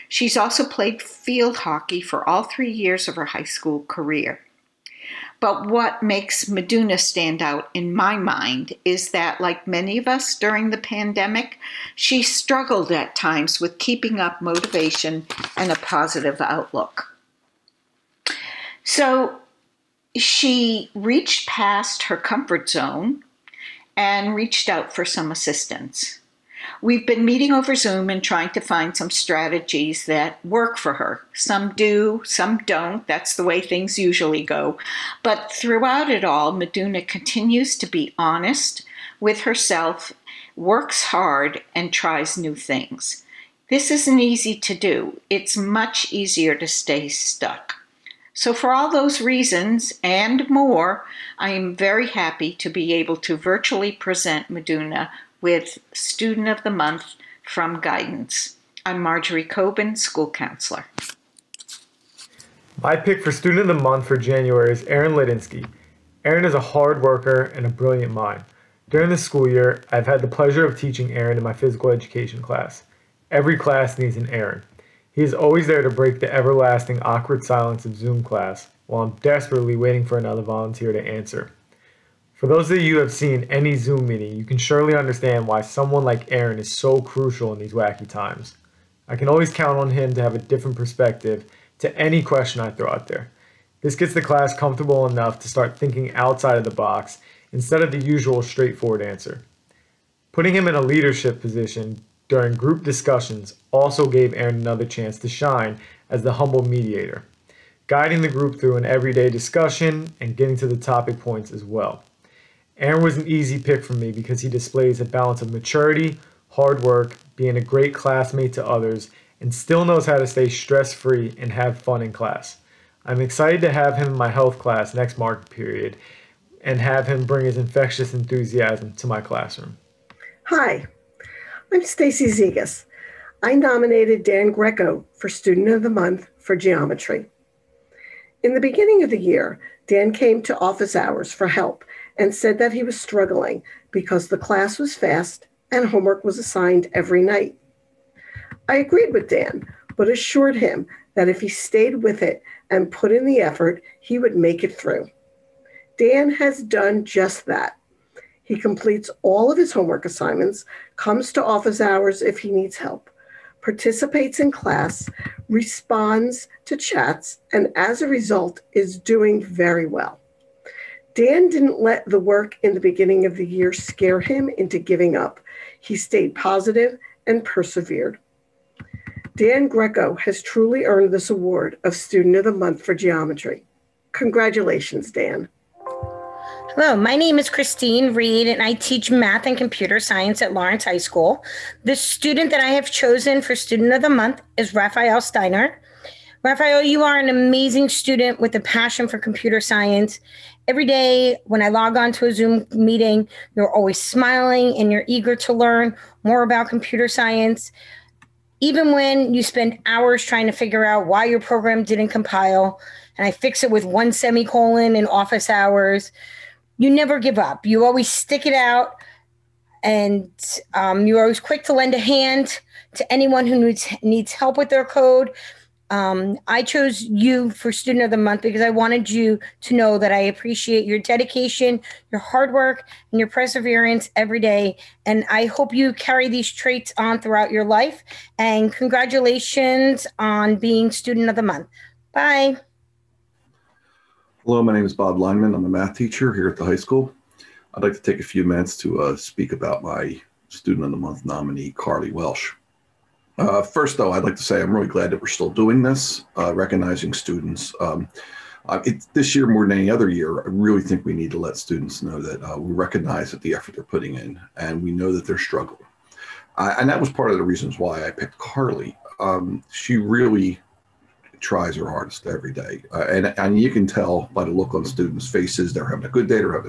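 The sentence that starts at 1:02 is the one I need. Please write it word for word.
My pick for Student of the Month for January is Aaron Litinsky.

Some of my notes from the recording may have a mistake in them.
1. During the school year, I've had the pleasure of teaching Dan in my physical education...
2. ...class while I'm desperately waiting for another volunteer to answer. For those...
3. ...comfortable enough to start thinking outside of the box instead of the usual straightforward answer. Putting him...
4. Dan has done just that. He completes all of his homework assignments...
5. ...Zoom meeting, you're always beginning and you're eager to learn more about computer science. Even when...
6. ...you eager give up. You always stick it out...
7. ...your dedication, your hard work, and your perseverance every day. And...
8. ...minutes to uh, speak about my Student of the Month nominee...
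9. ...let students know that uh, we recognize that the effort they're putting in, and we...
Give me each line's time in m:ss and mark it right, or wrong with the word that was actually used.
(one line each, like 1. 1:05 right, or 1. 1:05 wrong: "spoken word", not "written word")
1. 1:08 wrong: "Aaron", not "Dan"
2. 1:18 right
3. 1:34 right
4. 2:35 right
5. 3:22 wrong: "smiling", not "beginning"
6. 3:36 wrong: "never", not "eager"
7. 3:50 right
8. 4:08 right
9. 4:21 right.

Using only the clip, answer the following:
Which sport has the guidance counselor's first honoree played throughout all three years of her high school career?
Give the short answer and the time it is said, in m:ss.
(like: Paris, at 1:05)
Field hockey, at 0:01.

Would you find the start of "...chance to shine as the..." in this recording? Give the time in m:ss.
1:44.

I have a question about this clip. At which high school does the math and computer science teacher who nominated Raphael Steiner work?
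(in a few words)
Lawrence High School.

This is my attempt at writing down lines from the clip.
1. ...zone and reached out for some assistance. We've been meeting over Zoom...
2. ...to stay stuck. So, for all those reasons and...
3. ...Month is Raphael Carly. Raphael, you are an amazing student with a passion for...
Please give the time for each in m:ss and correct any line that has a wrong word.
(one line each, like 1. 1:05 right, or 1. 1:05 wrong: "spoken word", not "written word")
1. 0:22 right
2. 0:46 right
3. 3:14 wrong: "Steiner", not "Carly".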